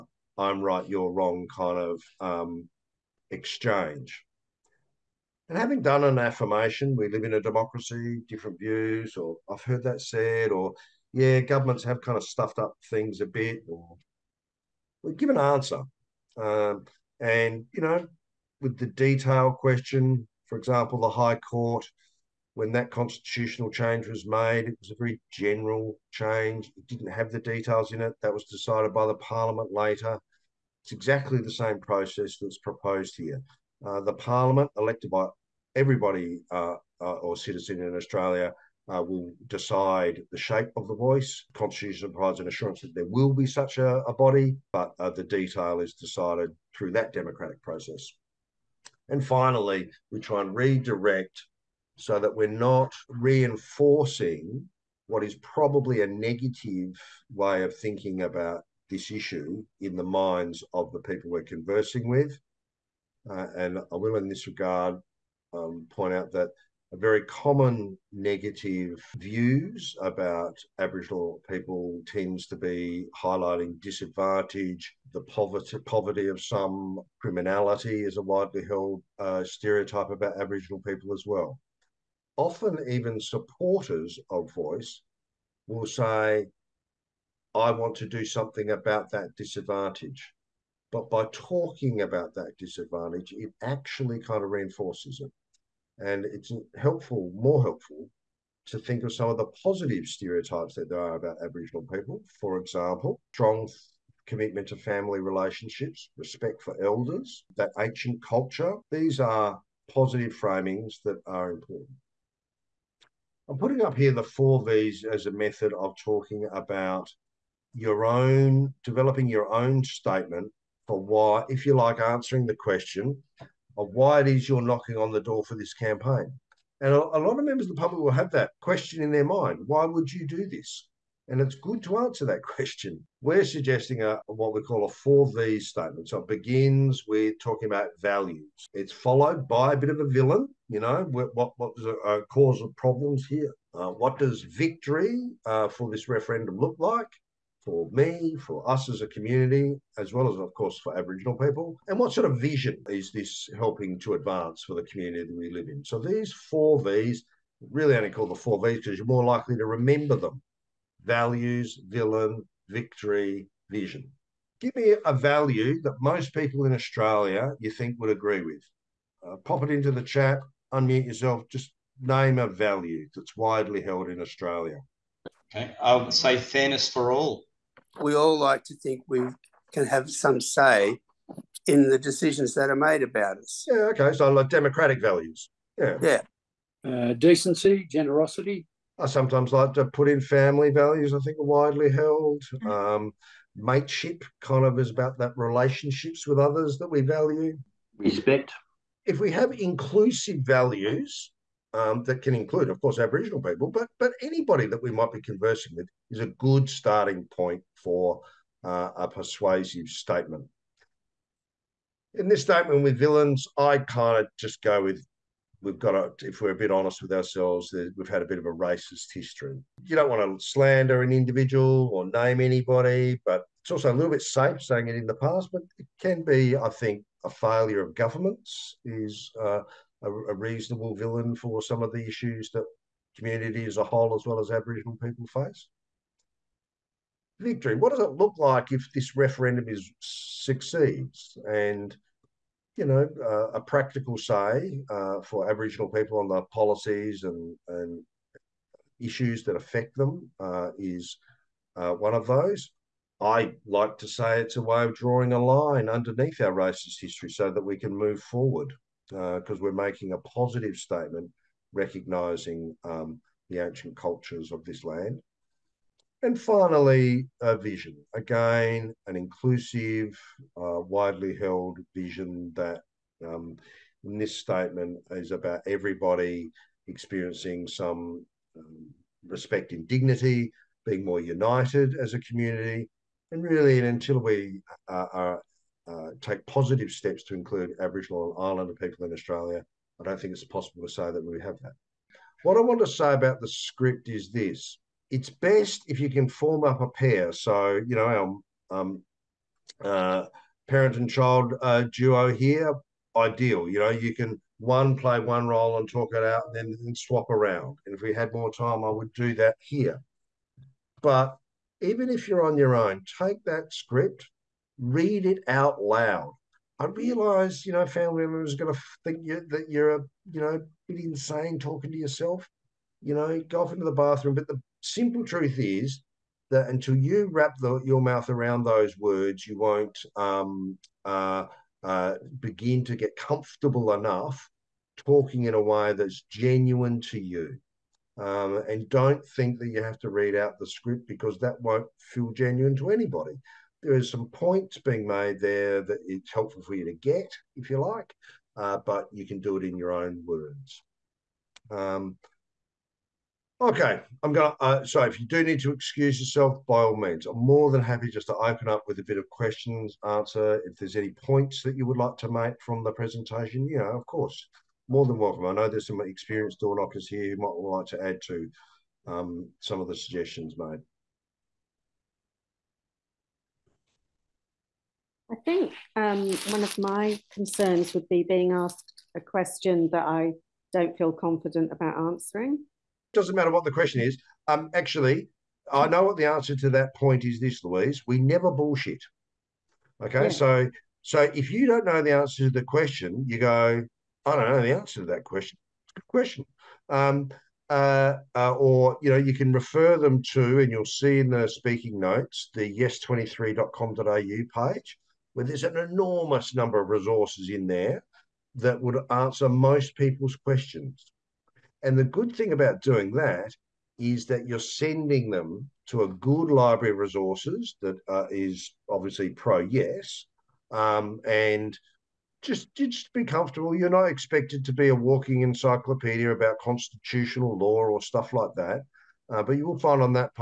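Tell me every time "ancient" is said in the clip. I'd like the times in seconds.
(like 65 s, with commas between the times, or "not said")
107 s, 263 s.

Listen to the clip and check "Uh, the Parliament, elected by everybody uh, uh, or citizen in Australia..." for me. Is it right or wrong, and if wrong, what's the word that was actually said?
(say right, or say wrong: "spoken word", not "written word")
right.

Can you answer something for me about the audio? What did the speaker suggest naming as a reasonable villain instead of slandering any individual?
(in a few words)
failure of governments.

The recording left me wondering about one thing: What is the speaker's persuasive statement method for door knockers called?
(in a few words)
4V statement.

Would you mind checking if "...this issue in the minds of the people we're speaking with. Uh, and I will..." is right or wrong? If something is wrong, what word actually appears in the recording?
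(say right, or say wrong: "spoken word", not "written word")
wrong: "conversing", not "speaking".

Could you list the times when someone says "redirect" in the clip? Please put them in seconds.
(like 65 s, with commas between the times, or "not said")
50 s.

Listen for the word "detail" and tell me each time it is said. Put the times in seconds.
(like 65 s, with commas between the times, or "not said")
18 s, 27 s, 45 s.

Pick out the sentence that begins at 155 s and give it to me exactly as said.
So these four Vs, really only call the four Vs because you're more likely to remember them values, villain, victory, vision.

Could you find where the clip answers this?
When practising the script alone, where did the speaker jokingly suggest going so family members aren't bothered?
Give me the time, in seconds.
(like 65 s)
323 s.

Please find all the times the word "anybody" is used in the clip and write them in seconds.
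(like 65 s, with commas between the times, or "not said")
204 s, 222 s, 342 s.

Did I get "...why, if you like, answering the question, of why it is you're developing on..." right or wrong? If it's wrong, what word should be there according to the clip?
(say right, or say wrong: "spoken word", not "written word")
wrong: "knocking", not "developing".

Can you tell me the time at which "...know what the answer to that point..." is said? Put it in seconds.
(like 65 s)
385 s.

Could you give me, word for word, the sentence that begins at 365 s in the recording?
I know there's some experienced door knockers here who might like to add to um, some of the suggestions made.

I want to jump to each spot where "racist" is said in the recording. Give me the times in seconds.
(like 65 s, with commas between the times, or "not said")
218 s, 256 s.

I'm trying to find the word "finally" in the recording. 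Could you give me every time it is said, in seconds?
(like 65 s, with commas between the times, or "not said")
49 s, 266 s.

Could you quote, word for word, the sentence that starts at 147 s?
for me, for us as a community, as well as, of course, for Aboriginal people?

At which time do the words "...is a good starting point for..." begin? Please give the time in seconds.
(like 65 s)
206 s.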